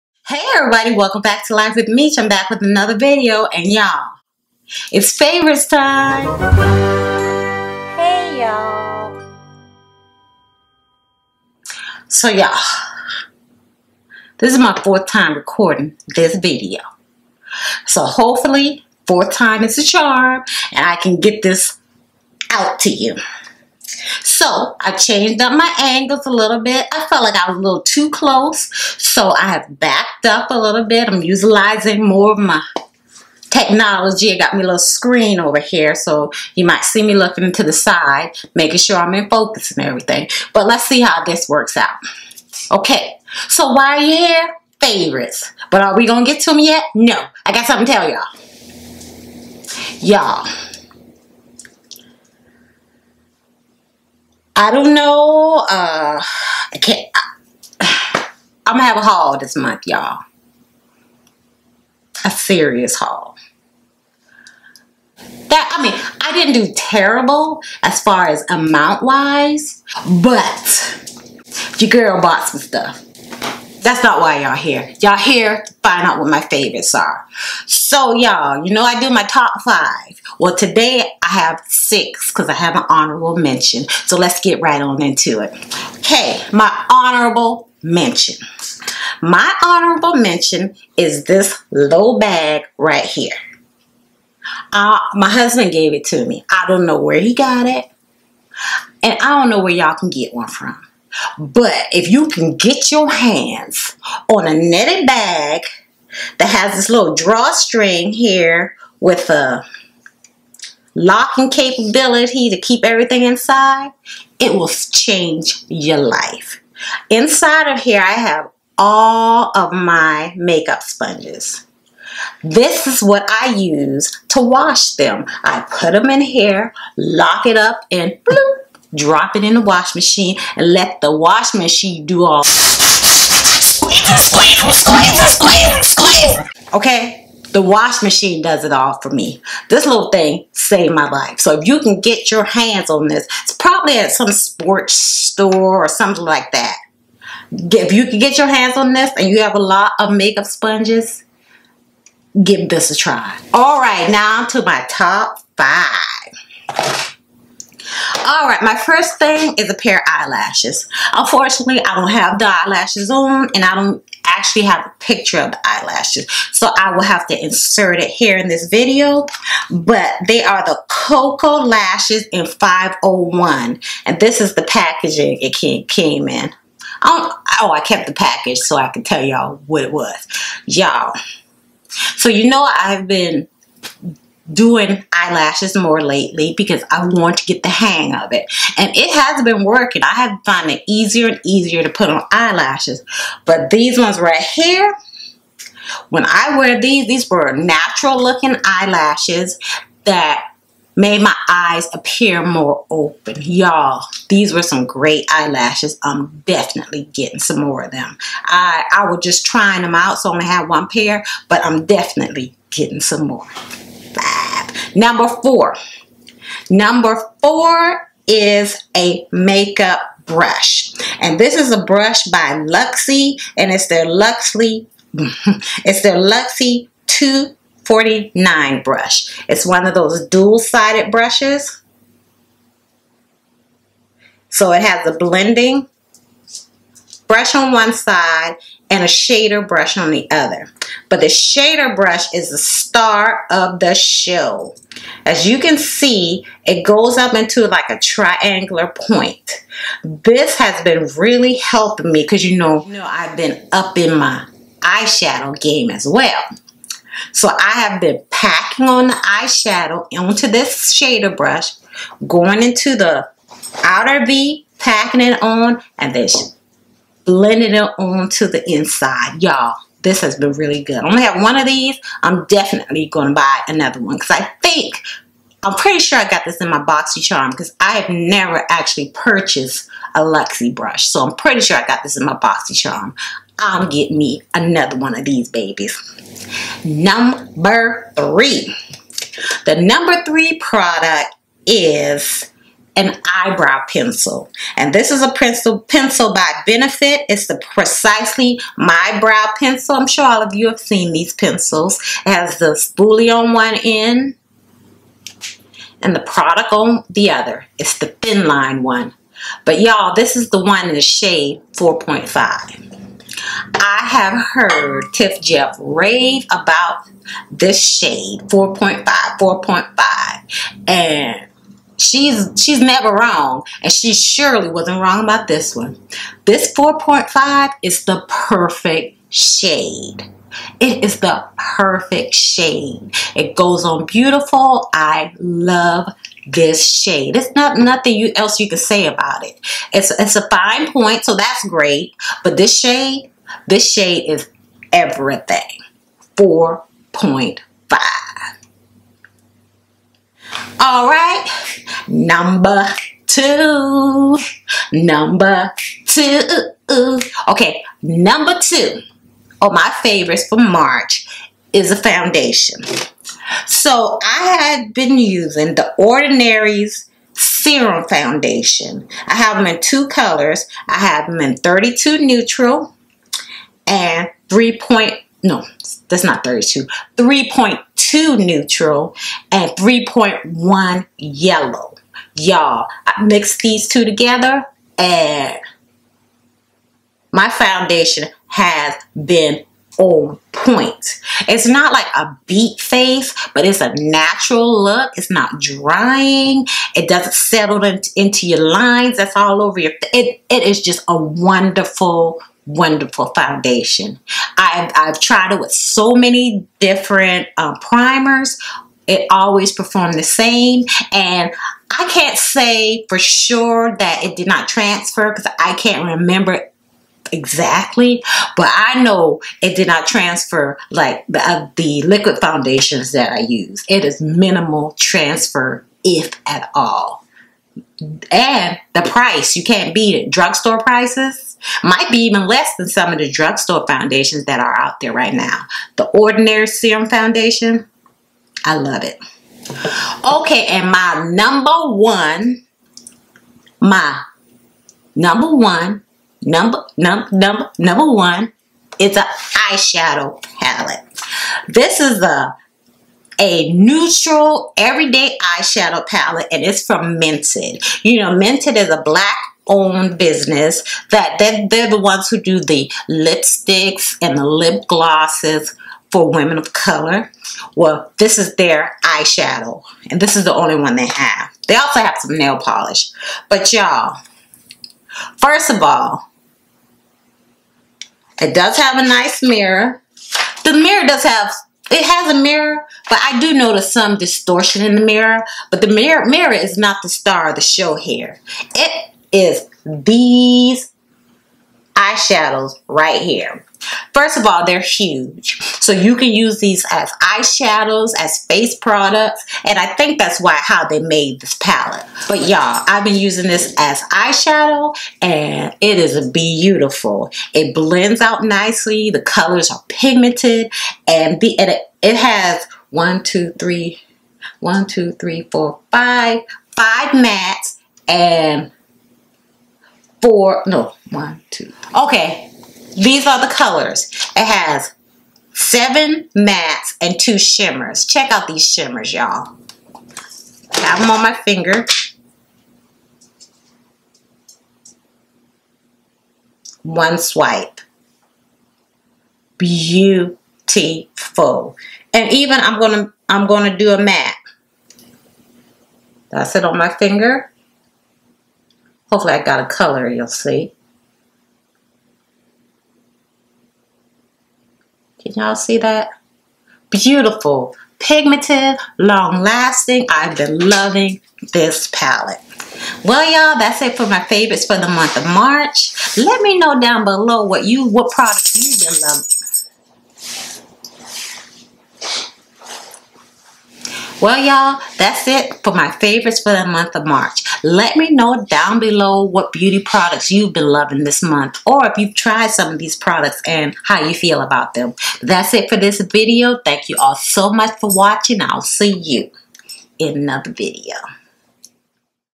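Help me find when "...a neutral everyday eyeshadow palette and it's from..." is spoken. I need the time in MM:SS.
07:33.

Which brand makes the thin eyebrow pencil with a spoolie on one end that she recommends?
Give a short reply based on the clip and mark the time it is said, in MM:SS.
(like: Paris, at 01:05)
Benefit, at 04:56.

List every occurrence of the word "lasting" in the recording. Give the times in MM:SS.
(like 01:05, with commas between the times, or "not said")
09:18.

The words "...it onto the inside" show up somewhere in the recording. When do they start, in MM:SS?
04:27.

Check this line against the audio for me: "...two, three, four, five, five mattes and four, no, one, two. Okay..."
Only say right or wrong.
right.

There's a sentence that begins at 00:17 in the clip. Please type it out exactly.
So hopefully, fourth time is a charm and I can get this out to you.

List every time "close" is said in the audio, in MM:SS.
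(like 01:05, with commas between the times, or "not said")
00:28.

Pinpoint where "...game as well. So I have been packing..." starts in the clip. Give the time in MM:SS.
04:15.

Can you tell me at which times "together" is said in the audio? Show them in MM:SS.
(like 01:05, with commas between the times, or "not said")
06:24.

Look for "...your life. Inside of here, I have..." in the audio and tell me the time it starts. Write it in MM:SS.
01:55.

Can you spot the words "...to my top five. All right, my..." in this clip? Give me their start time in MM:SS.
02:34.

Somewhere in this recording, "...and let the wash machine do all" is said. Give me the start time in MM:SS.
02:10.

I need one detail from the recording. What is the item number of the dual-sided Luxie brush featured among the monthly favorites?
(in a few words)
249.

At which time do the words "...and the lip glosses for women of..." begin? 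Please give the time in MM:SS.
07:44.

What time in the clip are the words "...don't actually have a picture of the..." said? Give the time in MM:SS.
02:43.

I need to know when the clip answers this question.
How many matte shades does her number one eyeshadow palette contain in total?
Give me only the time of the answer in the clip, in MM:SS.
08:45.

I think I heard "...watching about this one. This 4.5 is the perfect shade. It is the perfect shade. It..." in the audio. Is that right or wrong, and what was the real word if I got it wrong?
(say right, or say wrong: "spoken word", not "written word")
wrong: "wrong", not "watching".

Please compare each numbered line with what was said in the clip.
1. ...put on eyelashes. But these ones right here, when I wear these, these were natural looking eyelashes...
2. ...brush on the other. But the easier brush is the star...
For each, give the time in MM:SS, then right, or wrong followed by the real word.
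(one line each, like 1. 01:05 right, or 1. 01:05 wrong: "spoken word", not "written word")
1. 03:11 right
2. 03:59 wrong: "shader", not "easier".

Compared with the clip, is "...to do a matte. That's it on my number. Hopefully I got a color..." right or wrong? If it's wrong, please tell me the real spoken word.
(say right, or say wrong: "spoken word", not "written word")
wrong: "finger", not "number".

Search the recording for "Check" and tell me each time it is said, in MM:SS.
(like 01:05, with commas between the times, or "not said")
08:48.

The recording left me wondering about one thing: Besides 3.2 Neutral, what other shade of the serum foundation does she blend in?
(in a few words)
3.1 Yellow.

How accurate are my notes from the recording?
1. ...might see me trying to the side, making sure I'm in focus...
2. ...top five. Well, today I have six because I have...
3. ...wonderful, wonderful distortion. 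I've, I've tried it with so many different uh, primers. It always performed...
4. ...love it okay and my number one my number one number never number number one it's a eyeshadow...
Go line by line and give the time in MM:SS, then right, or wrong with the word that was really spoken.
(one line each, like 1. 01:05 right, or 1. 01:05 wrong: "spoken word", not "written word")
1. 00:36 wrong: "looking", not "trying"
2. 01:19 right
3. 06:41 wrong: "foundation", not "distortion"
4. 07:18 wrong: "number", not "never".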